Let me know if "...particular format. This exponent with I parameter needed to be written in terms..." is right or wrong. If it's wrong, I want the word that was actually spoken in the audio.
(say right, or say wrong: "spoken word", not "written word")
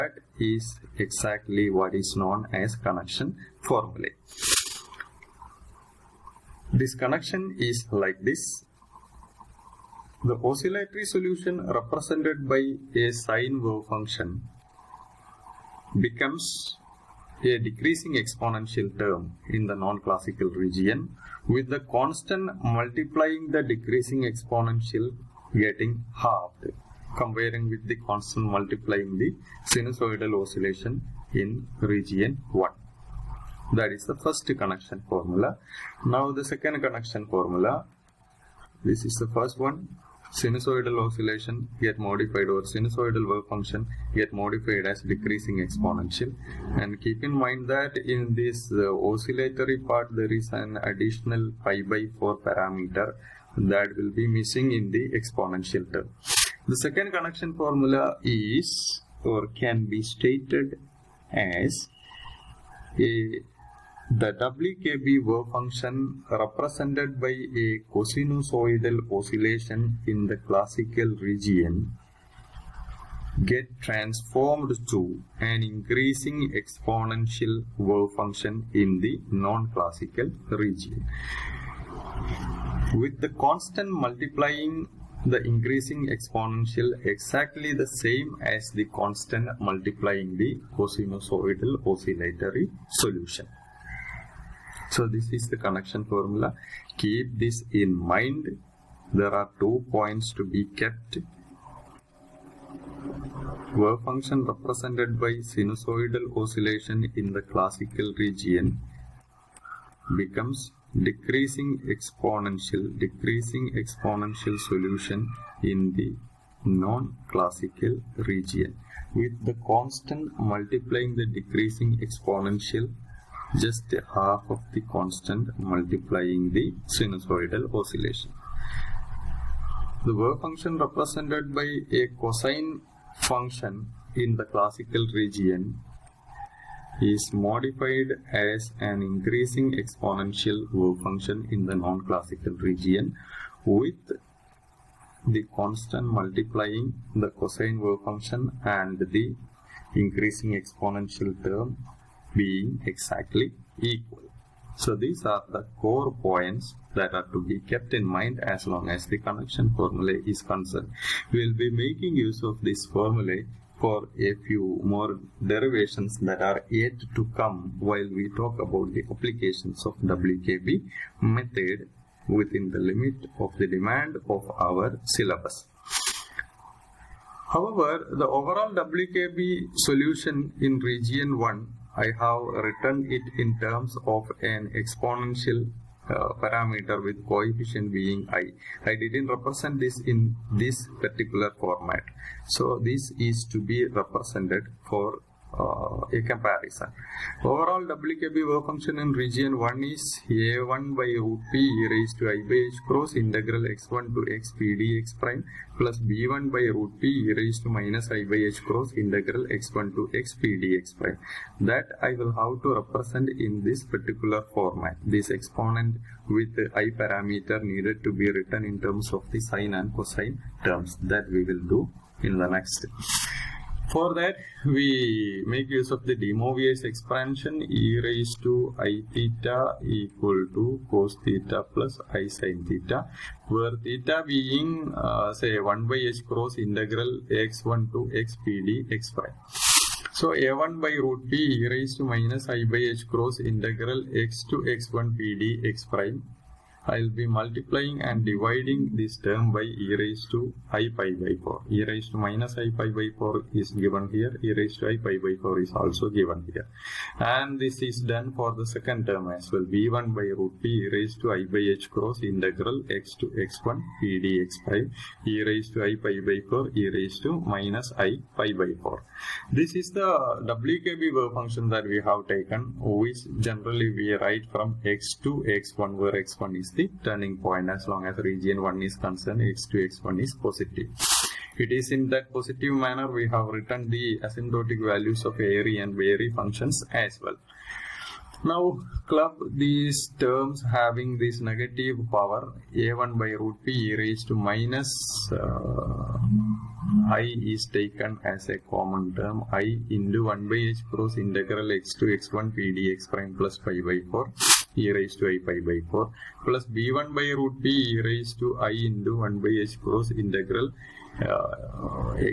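right.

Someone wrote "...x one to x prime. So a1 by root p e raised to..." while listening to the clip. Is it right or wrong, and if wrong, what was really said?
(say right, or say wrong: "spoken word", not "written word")
right.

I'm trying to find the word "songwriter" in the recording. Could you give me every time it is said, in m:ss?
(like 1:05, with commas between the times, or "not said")
not said.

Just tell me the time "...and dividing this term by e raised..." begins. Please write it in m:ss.
4:08.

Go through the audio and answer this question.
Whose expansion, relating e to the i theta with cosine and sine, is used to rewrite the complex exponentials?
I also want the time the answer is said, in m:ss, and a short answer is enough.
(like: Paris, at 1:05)
de Moivre, at 3:46.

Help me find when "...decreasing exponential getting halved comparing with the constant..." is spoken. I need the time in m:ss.
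0:23.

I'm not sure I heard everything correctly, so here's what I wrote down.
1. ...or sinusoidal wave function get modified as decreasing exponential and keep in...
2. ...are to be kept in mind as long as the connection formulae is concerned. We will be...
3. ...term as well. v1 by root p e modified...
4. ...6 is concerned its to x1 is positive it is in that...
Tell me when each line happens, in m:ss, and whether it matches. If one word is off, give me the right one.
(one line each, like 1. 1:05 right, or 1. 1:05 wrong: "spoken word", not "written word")
1. 0:42 right
2. 2:37 right
3. 4:19 wrong: "raised", not "modified"
4. 4:38 wrong: "1", not "6".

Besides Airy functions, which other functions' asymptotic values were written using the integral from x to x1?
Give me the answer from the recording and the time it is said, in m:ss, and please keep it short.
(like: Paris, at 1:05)
Bairy functions, at 4:46.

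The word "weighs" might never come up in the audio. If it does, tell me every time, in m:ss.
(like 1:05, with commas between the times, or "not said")
not said.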